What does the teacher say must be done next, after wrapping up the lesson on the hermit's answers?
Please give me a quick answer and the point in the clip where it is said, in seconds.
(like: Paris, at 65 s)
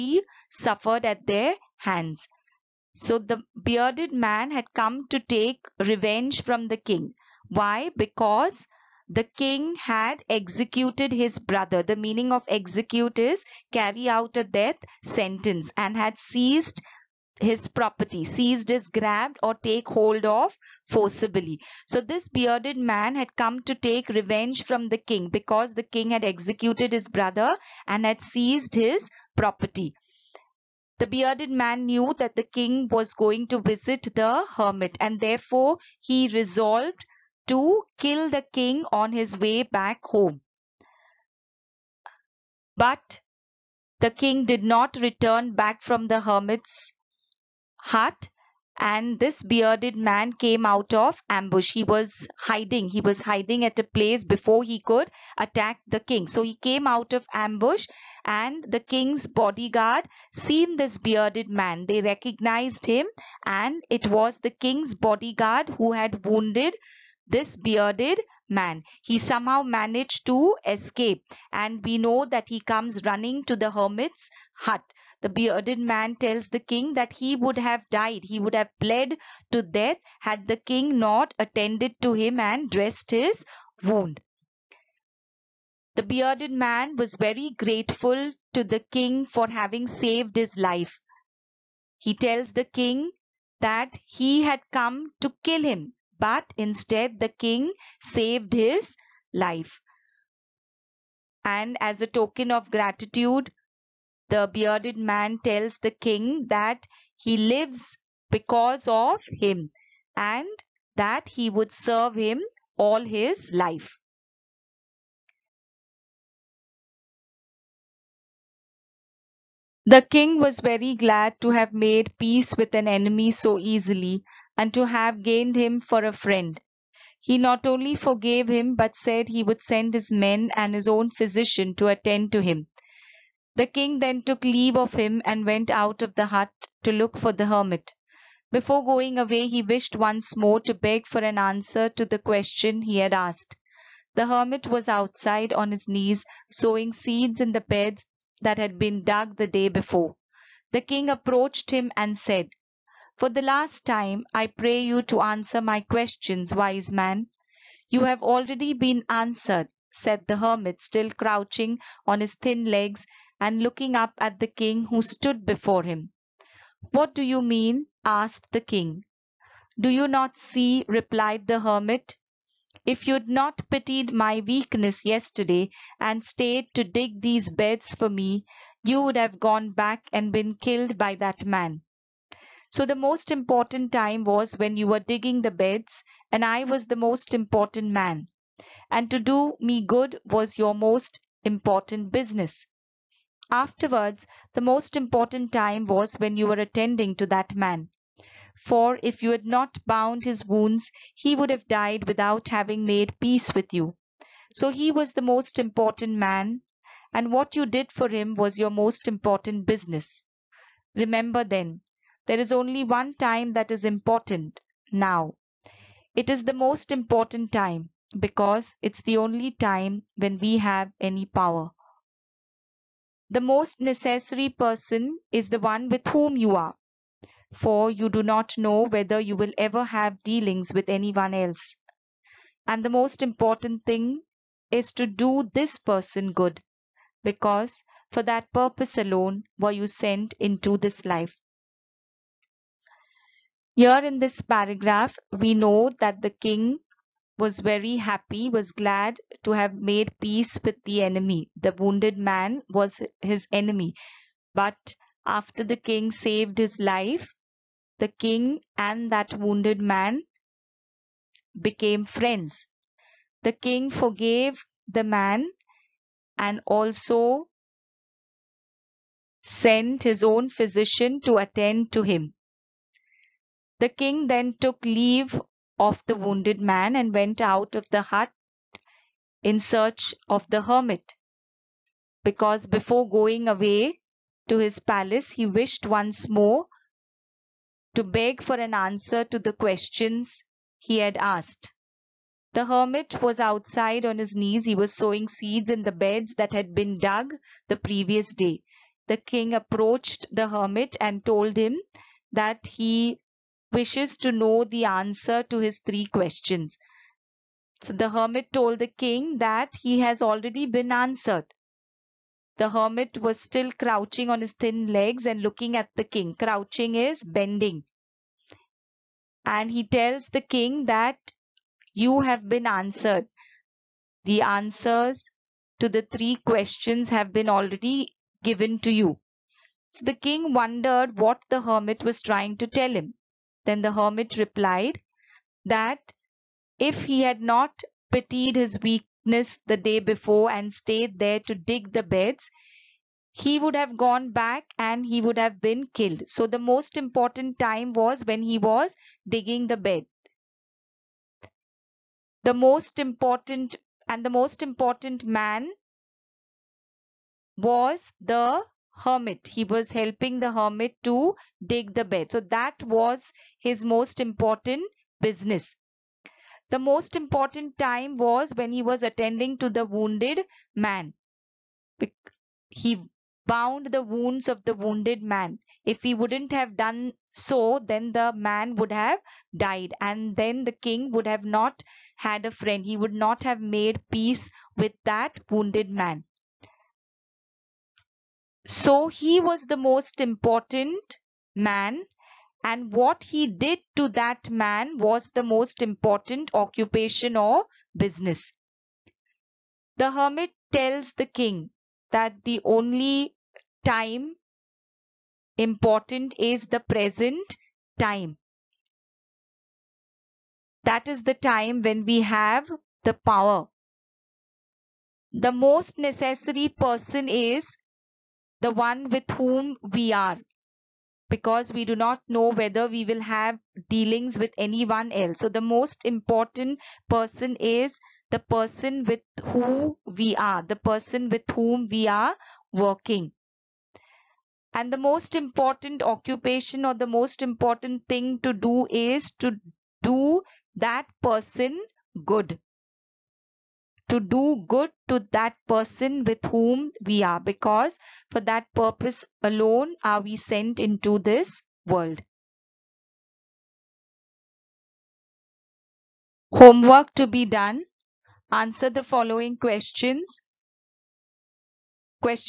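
Homework, at 456 s.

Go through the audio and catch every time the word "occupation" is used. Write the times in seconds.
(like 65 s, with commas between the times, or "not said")
396 s, 436 s.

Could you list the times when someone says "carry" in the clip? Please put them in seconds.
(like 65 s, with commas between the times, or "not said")
13 s.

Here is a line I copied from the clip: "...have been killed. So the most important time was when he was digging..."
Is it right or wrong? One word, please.
right.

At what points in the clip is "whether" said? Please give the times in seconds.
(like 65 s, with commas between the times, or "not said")
228 s, 422 s.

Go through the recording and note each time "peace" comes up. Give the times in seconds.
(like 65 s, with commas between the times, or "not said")
122 s, 203 s, 250 s, 384 s.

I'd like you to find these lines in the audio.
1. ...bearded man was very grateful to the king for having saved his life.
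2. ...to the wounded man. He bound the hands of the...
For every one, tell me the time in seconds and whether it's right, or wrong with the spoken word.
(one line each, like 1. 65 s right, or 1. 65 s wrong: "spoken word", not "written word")
1. 86 s right
2. 369 s wrong: "wounds", not "hands".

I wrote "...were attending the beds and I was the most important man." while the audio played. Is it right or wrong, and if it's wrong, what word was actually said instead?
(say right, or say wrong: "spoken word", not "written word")
wrong: "digging", not "attending".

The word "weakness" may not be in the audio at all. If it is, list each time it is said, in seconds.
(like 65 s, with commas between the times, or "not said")
174 s, 338 s.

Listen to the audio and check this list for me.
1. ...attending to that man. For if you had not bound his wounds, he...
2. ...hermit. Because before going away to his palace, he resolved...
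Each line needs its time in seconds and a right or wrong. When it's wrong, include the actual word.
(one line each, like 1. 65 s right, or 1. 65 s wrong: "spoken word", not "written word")
1. 196 s right
2. 280 s wrong: "wished", not "resolved".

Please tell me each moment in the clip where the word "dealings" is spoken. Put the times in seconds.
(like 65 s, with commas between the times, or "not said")
230 s, 423 s.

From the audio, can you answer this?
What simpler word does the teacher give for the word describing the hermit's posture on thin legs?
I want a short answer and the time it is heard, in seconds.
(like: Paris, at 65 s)
Bending, at 316 s.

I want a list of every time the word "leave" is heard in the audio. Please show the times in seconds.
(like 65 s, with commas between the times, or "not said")
134 s, 274 s.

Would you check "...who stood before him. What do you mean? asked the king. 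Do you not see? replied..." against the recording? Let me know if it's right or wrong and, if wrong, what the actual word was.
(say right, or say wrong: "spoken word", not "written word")
right.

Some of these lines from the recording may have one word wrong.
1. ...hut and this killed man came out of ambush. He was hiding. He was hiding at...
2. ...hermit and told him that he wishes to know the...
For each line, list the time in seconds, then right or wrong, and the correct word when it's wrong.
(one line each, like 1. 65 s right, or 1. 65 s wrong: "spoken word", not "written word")
1. 47 s wrong: "bearded", not "killed"
2. 300 s right.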